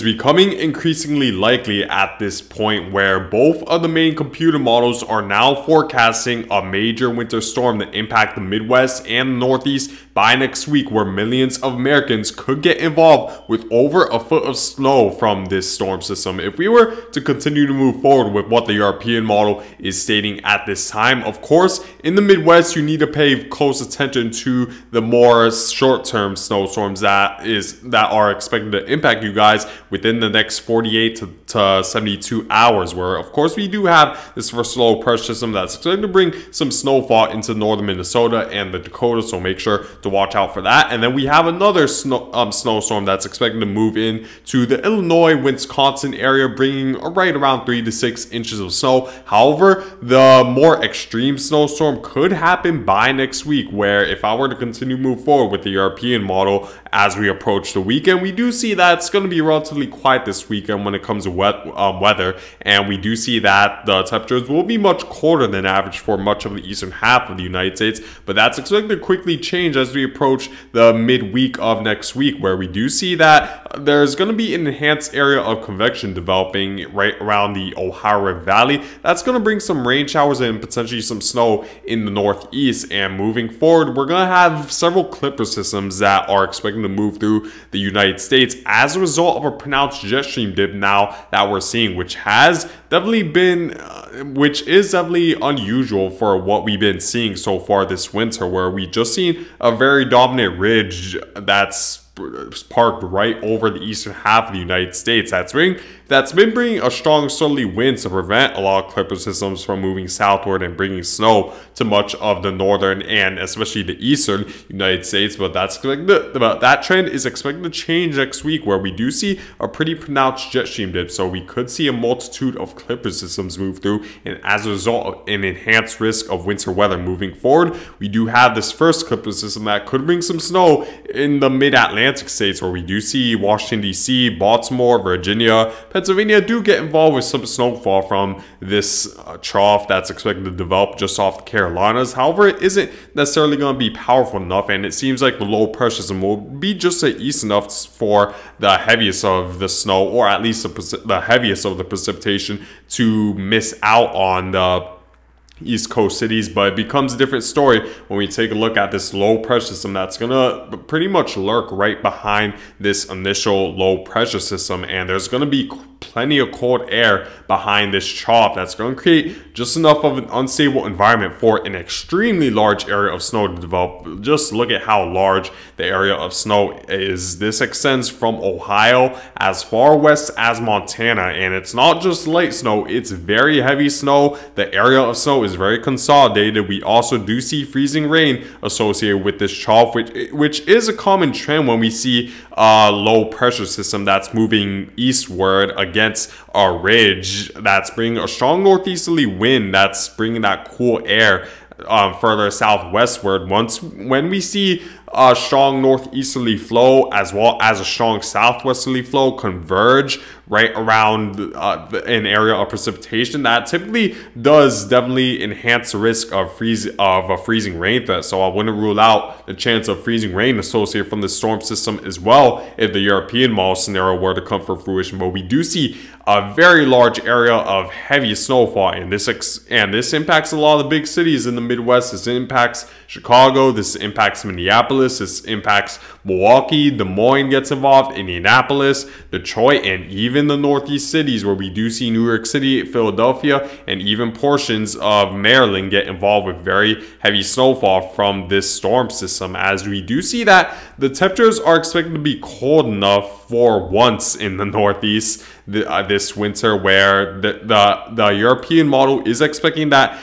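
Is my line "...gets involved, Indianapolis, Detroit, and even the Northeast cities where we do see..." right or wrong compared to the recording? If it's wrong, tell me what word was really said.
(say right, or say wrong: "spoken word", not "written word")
right.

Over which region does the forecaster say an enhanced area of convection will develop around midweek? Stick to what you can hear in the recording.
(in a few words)
Ohio Valley.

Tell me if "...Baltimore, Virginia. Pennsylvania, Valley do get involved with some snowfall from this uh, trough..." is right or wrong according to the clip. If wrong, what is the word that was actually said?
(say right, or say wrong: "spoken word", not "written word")
wrong: "Pennsylvania", not "Valley".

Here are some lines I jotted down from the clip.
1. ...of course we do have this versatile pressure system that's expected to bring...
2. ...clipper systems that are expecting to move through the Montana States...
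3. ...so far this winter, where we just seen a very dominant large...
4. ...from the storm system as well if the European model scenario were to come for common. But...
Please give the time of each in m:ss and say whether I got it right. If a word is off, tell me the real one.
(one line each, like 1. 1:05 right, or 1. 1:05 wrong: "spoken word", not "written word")
1. 0:33 right
2. 1:25 wrong: "United", not "Montana"
3. 1:37 wrong: "ridge", not "large"
4. 3:41 wrong: "fruition", not "common".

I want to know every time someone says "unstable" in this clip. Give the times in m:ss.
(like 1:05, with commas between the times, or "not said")
2:50.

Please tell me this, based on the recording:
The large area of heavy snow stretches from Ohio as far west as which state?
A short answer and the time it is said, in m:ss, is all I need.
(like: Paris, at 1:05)
Montana, at 3:00.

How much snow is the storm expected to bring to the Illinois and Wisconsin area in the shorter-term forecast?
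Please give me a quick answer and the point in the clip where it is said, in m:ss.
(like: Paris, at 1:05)
3 to 6 inches, at 0:47.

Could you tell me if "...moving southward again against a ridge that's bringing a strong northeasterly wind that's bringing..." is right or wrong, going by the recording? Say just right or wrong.
wrong.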